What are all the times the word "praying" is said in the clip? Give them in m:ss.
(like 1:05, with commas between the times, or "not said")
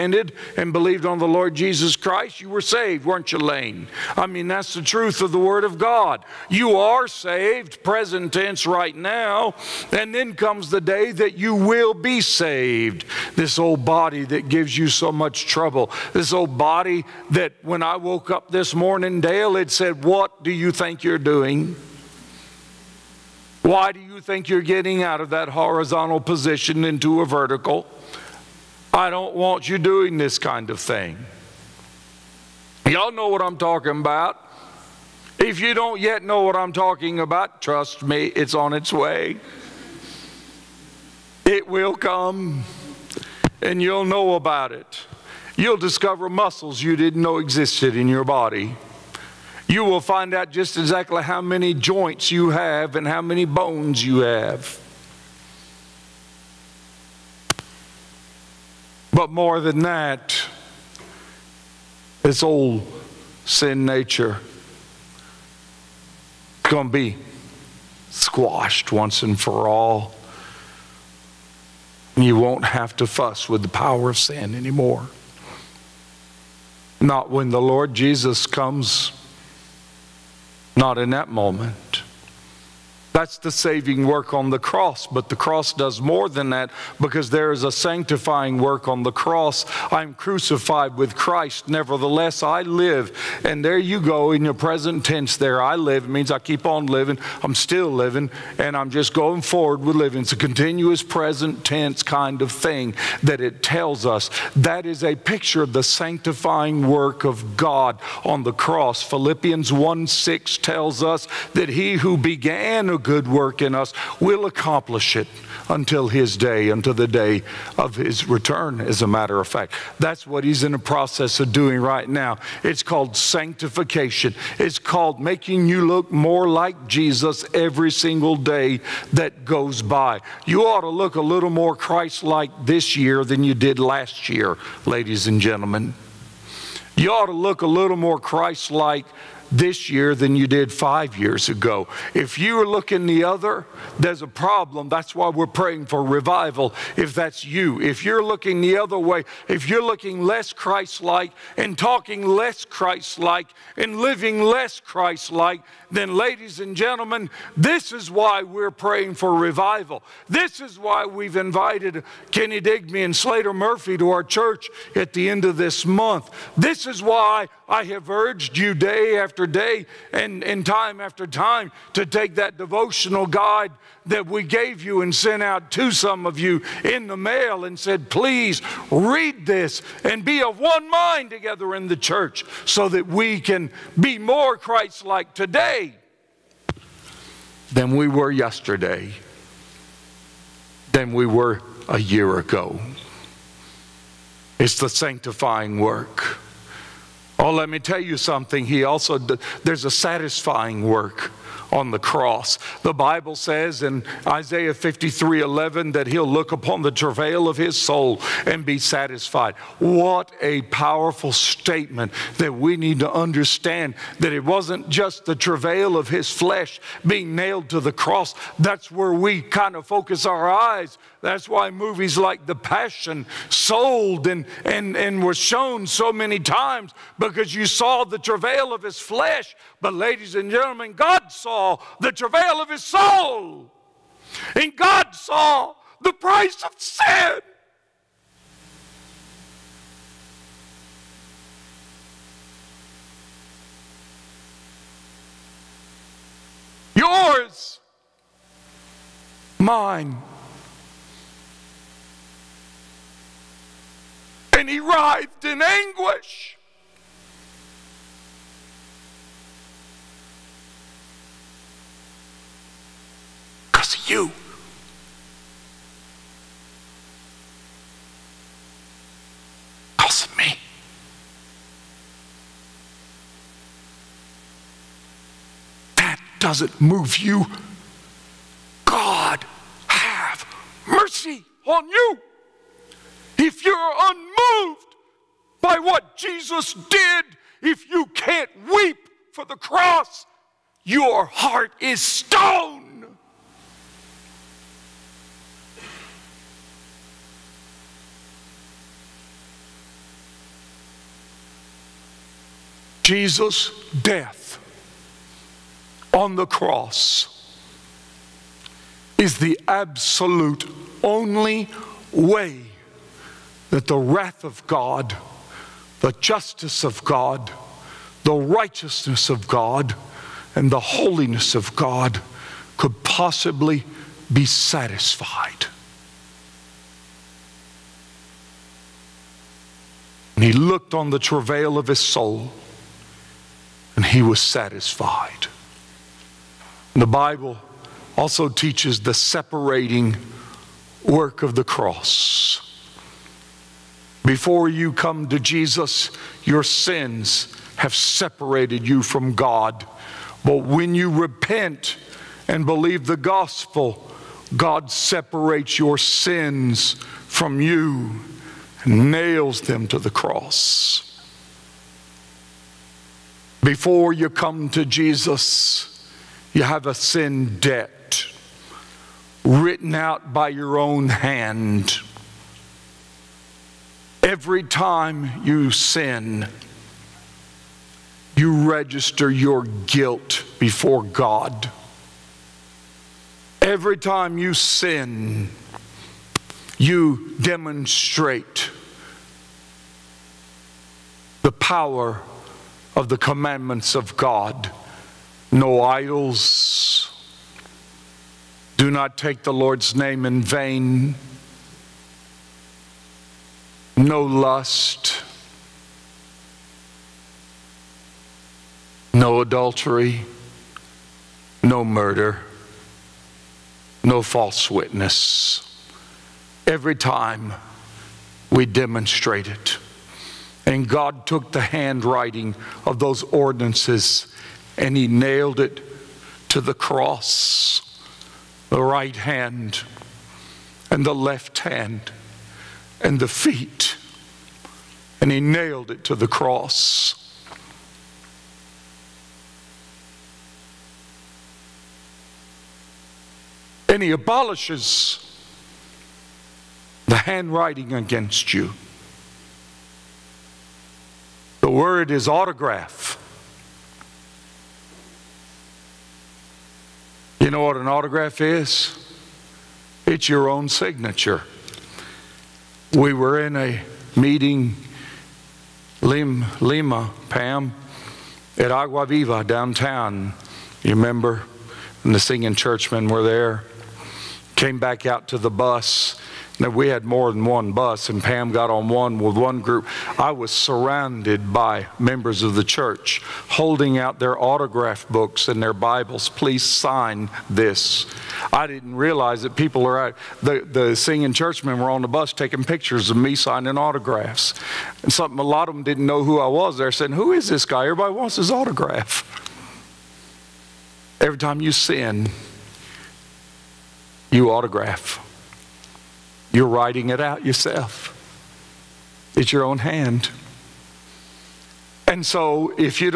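2:25, 2:38.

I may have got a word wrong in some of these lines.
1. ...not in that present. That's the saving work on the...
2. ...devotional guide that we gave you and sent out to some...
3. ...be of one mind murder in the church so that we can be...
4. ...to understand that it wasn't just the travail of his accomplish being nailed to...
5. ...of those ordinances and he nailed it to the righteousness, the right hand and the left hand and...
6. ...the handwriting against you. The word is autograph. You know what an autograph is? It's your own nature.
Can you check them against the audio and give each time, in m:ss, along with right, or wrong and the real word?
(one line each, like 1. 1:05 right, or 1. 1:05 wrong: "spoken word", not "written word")
1. 1:20 wrong: "moment", not "present"
2. 2:52 right
3. 3:00 wrong: "together", not "murder"
4. 3:32 wrong: "flesh", not "accomplish"
5. 7:02 wrong: "cross", not "righteousness"
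6. 7:27 wrong: "signature", not "nature".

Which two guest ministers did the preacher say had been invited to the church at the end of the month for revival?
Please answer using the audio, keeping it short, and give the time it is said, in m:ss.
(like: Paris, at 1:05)
Kenny Digby and Slater Murphy, at 2:42.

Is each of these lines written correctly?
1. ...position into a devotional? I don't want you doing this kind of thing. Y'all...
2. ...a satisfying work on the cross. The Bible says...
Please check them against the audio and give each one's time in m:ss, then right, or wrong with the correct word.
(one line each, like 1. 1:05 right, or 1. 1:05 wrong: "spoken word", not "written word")
1. 0:26 wrong: "vertical", not "devotional"
2. 3:19 right.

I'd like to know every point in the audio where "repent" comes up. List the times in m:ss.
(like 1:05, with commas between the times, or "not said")
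5:51.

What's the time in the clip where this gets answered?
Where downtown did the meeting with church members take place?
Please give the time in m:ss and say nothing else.
7:48.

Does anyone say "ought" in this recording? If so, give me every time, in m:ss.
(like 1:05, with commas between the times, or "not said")
2:10, 2:17.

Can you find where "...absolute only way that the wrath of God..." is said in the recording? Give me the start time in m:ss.
5:09.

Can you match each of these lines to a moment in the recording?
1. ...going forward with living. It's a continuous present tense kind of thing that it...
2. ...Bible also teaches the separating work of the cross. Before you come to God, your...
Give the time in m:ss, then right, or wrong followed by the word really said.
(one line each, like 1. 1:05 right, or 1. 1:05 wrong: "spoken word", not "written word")
1. 1:39 right
2. 5:37 wrong: "Jesus", not "God".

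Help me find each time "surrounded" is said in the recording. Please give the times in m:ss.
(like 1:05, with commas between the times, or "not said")
8:00.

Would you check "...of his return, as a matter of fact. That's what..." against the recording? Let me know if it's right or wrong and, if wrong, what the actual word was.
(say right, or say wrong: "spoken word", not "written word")
right.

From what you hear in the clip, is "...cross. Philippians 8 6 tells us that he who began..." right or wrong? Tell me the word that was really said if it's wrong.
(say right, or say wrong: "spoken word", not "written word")
wrong: "1", not "8".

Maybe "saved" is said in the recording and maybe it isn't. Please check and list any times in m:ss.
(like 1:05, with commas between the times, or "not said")
0:02, 0:07, 0:12.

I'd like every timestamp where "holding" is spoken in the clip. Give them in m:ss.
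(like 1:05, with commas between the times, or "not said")
8:03.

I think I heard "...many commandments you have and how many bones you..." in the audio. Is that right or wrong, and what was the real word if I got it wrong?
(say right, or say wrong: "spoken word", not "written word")
wrong: "joints", not "commandments".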